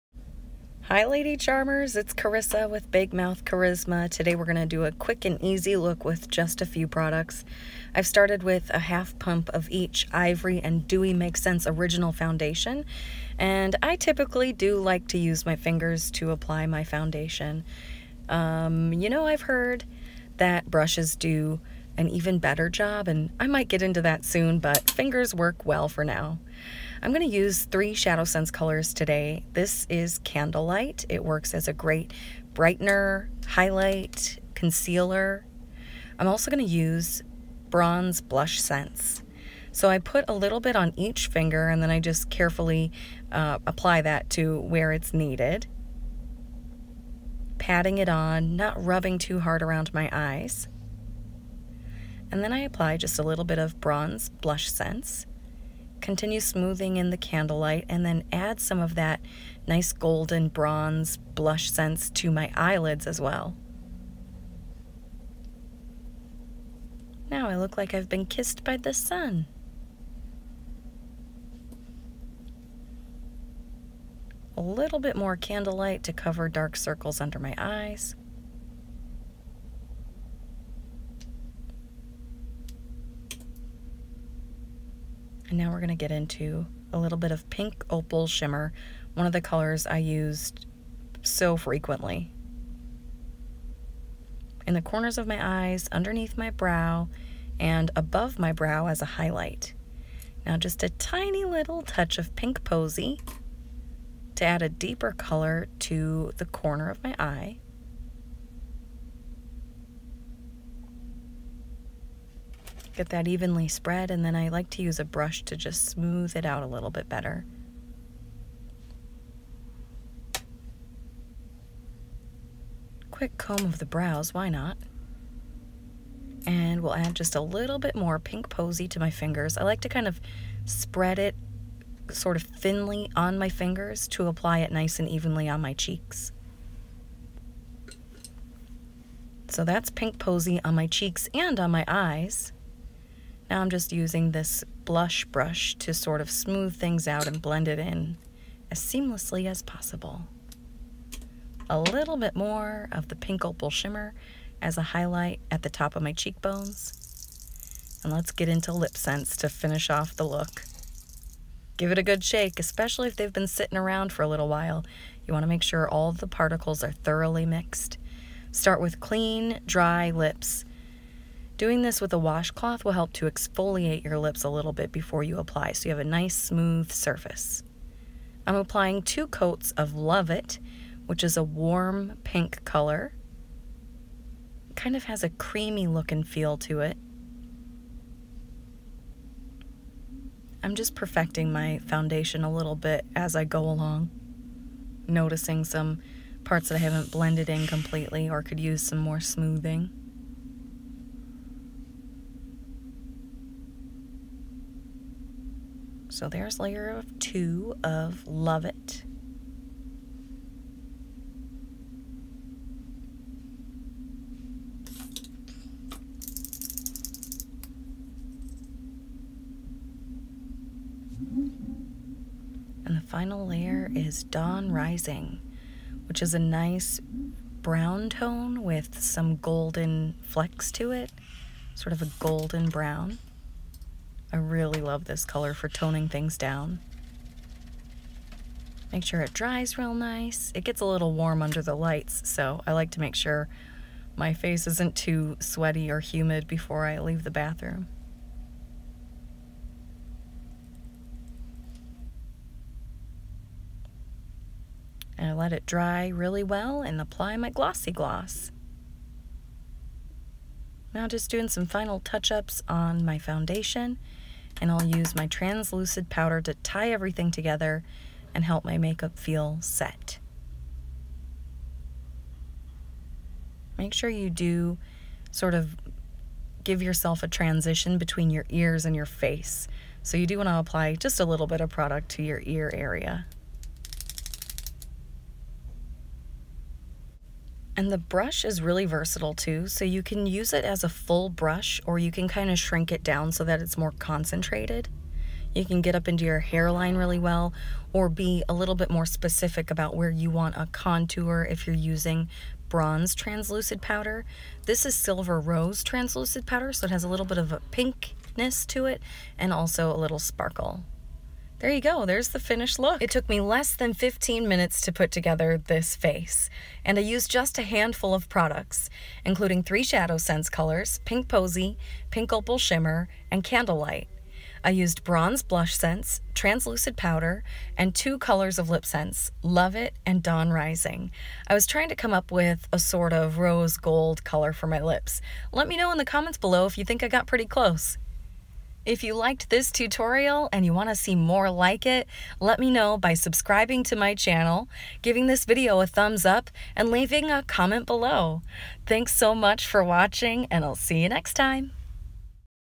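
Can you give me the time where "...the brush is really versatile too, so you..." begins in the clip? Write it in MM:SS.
04:47.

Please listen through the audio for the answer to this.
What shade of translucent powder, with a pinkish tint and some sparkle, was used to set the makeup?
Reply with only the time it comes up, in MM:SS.
05:04.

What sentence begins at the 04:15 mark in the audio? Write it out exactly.
And I let it dry really well and apply my glossy gloss.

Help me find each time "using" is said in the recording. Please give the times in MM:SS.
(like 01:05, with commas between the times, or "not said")
02:23, 05:01.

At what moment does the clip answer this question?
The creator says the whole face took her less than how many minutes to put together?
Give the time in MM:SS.
05:13.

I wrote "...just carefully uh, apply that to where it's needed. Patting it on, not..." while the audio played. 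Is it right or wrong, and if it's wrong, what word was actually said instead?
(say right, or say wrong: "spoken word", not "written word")
right.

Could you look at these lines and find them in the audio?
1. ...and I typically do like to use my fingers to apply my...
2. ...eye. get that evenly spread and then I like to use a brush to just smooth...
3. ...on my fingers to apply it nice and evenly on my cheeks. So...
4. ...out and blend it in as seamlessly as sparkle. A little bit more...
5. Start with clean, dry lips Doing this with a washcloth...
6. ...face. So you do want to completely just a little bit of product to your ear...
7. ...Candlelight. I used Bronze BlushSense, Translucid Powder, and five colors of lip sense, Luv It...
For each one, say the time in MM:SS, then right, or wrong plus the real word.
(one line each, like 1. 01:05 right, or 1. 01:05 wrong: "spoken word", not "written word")
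1. 00:13 right
2. 01:47 right
3. 02:13 right
4. 02:27 wrong: "possible", not "sparkle"
5. 02:48 right
6. 04:39 wrong: "apply", not "completely"
7. 05:23 wrong: "two", not "five".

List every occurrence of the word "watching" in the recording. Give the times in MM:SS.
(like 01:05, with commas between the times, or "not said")
05:49.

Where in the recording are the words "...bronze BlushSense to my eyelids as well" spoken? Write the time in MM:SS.
01:00.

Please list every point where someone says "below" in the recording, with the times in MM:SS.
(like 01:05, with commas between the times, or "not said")
05:36, 05:47.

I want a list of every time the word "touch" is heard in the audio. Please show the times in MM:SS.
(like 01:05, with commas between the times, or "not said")
01:41, 04:21.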